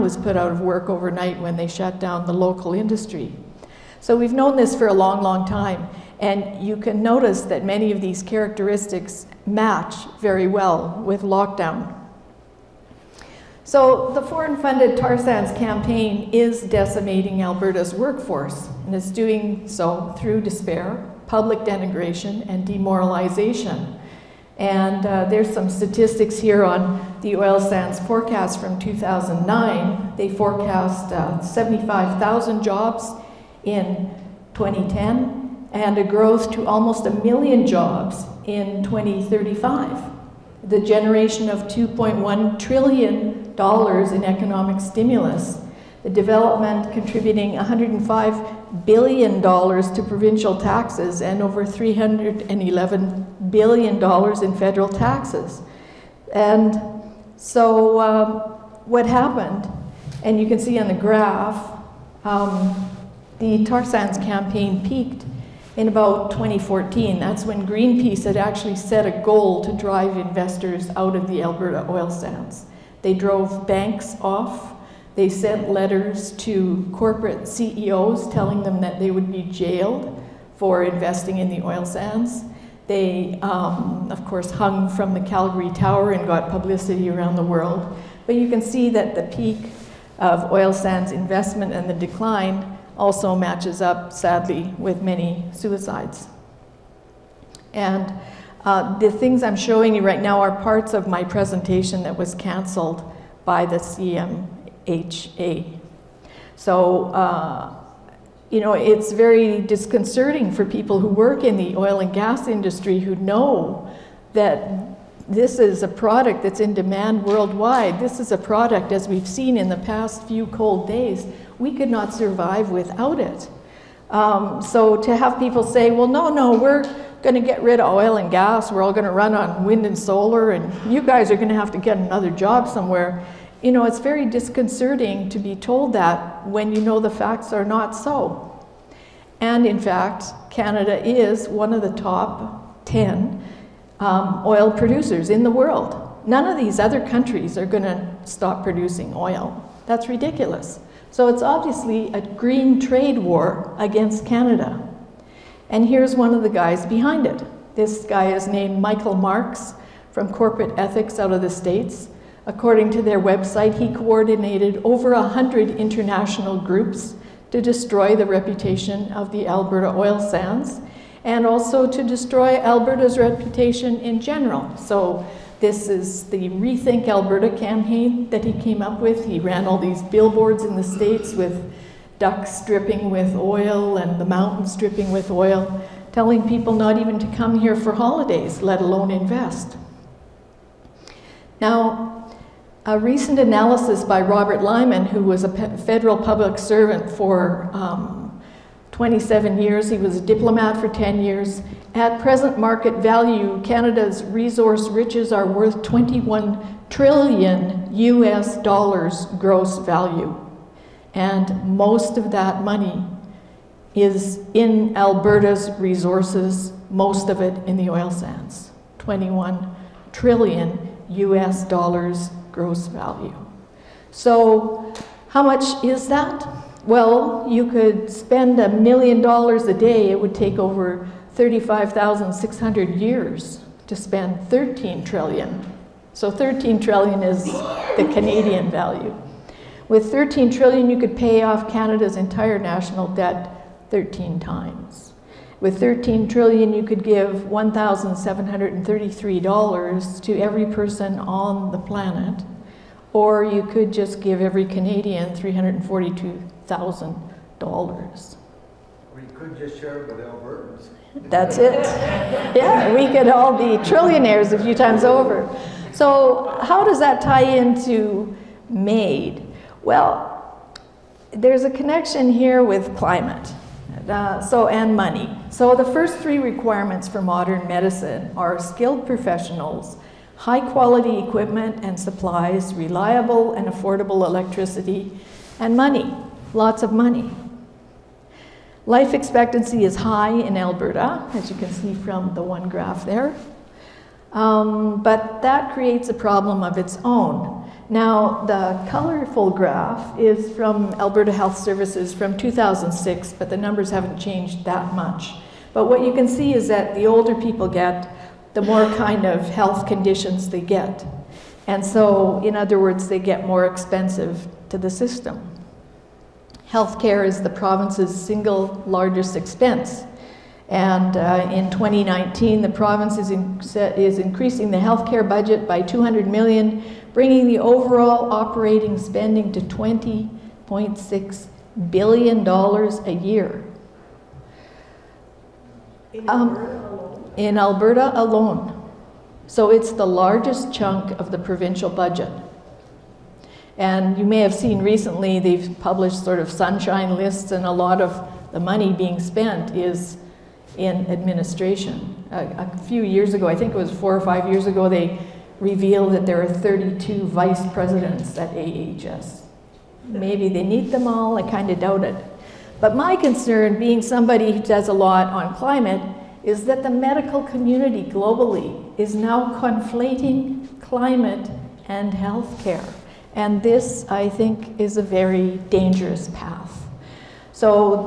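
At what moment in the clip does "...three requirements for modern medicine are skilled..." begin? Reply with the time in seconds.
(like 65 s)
276 s.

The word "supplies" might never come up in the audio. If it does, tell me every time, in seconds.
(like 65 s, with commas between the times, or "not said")
281 s.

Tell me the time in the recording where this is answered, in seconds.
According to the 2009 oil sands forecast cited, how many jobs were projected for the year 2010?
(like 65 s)
31 s.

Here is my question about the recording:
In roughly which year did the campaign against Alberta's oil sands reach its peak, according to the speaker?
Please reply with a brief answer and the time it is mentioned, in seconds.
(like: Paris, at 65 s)
2014, at 66 s.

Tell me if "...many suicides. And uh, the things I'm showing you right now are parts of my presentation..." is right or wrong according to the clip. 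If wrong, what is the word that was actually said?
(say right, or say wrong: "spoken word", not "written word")
right.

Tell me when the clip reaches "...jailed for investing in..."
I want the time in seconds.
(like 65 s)
79 s.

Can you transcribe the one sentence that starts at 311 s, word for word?
And so, in other words, they get more expensive to the system.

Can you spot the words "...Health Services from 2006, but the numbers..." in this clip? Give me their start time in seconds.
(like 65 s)
301 s.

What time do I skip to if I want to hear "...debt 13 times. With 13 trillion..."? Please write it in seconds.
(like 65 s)
243 s.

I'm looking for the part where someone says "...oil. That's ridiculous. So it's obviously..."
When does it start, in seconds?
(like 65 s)
149 s.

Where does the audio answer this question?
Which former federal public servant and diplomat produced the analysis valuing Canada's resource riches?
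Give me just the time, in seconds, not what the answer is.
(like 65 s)
194 s.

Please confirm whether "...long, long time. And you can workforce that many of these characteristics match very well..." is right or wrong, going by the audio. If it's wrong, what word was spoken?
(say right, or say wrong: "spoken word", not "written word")
wrong: "notice", not "workforce".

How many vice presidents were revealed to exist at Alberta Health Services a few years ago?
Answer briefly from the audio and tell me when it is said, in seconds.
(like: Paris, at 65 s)
32, at 356 s.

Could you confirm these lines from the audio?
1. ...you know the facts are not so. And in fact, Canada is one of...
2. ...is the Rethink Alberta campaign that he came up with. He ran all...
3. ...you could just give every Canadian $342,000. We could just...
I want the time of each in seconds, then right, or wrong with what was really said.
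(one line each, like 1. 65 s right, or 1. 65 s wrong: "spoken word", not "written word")
1. 136 s right
2. 175 s right
3. 253 s right.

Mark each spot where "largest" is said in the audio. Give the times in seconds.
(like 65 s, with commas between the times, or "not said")
318 s, 340 s.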